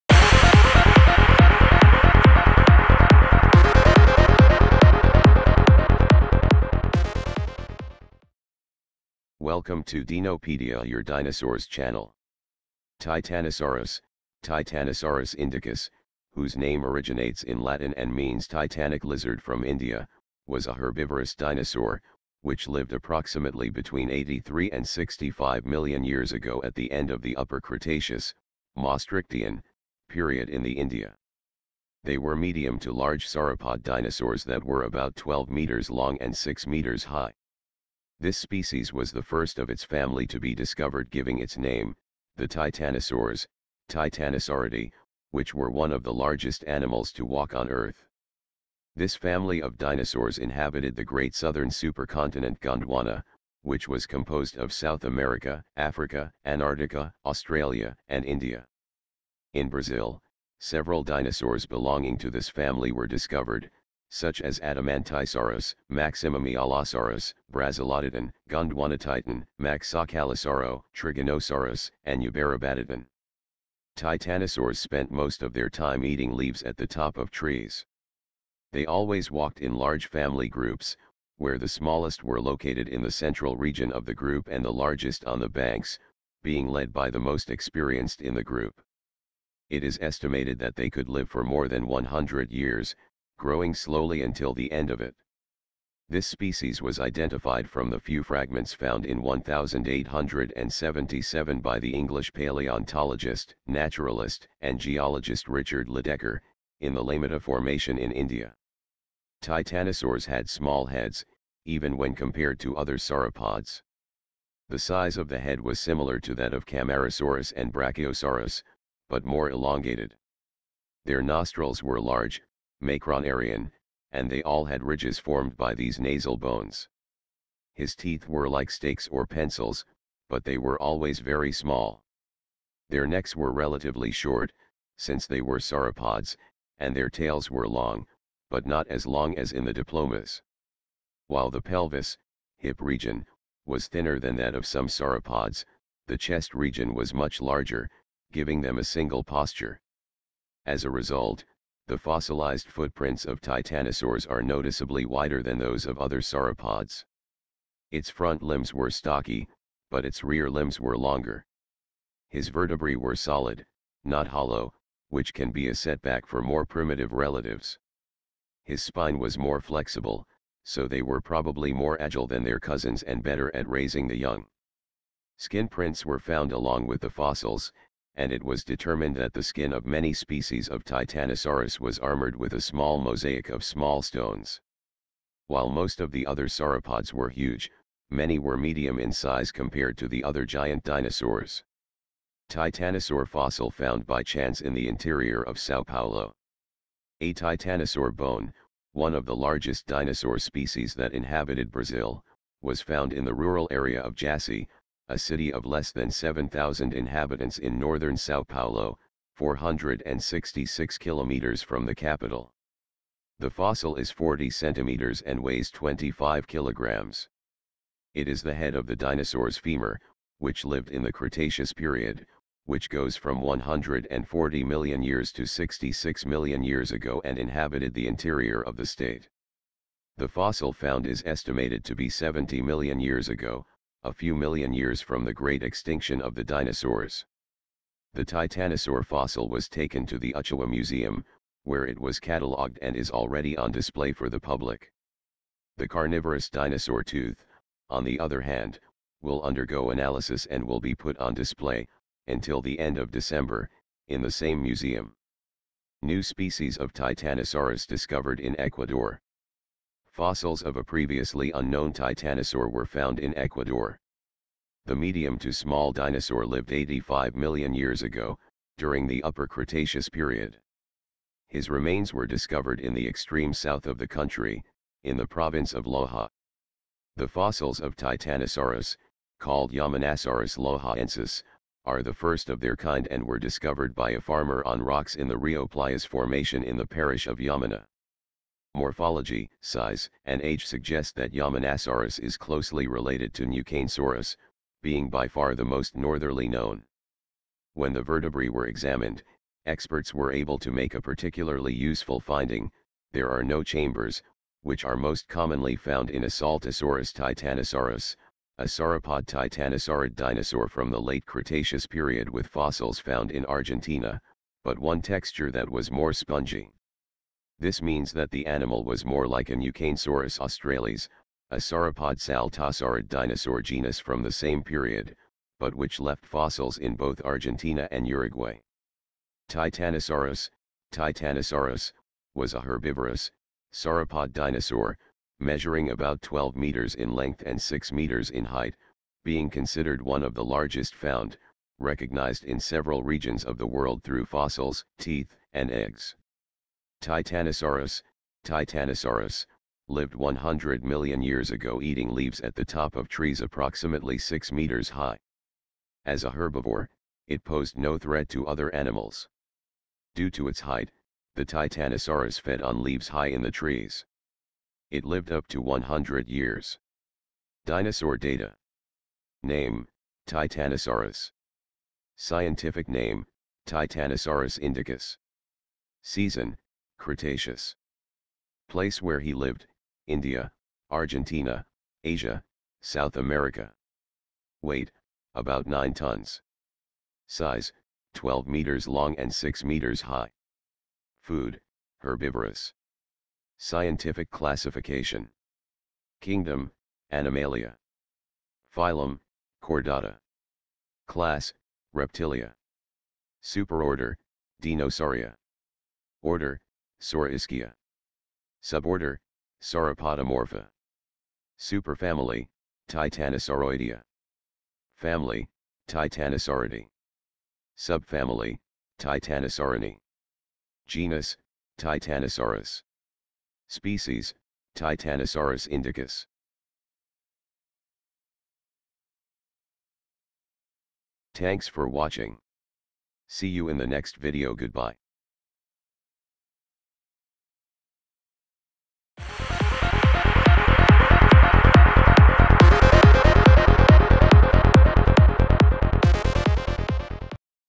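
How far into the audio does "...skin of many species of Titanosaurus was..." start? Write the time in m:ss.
2:59.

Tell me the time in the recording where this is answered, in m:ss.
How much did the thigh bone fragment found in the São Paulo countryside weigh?
3:35.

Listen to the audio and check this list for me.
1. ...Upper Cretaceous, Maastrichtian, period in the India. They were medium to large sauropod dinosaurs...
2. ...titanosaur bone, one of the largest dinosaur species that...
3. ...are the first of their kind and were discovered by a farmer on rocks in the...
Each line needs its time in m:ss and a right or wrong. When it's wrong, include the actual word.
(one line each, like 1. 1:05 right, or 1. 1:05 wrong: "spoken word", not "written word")
1. 0:27 right
2. 3:17 right
3. 4:41 right.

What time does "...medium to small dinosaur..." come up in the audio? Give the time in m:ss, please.
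4:24.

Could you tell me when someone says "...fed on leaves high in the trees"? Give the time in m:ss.
6:02.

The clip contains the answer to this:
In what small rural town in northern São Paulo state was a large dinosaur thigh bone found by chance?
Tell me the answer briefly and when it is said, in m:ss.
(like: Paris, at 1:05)
Jaci, at 3:24.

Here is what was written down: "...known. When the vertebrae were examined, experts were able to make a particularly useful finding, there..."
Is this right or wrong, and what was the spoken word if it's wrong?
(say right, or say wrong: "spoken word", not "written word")
right.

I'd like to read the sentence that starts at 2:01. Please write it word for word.
Their nostrils were large, Macronarian, and they all had ridges formed by these nasal bones.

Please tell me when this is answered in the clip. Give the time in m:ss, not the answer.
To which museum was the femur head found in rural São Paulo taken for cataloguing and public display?
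4:00.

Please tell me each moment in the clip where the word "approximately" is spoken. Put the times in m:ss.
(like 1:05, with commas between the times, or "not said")
0:22, 5:53.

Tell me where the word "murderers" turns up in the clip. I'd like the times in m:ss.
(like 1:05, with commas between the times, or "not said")
not said.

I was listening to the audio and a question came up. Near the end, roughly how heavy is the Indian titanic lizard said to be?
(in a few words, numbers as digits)
about 9 tons.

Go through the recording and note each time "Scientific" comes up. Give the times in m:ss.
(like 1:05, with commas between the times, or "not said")
6:12, 6:33.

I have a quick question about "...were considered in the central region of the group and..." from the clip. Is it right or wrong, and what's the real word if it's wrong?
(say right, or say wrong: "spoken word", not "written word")
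wrong: "located", not "considered".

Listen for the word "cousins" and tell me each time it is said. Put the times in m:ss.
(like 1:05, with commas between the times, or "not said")
2:52.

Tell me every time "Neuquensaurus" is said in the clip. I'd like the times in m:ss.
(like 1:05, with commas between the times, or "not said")
4:53, 5:19.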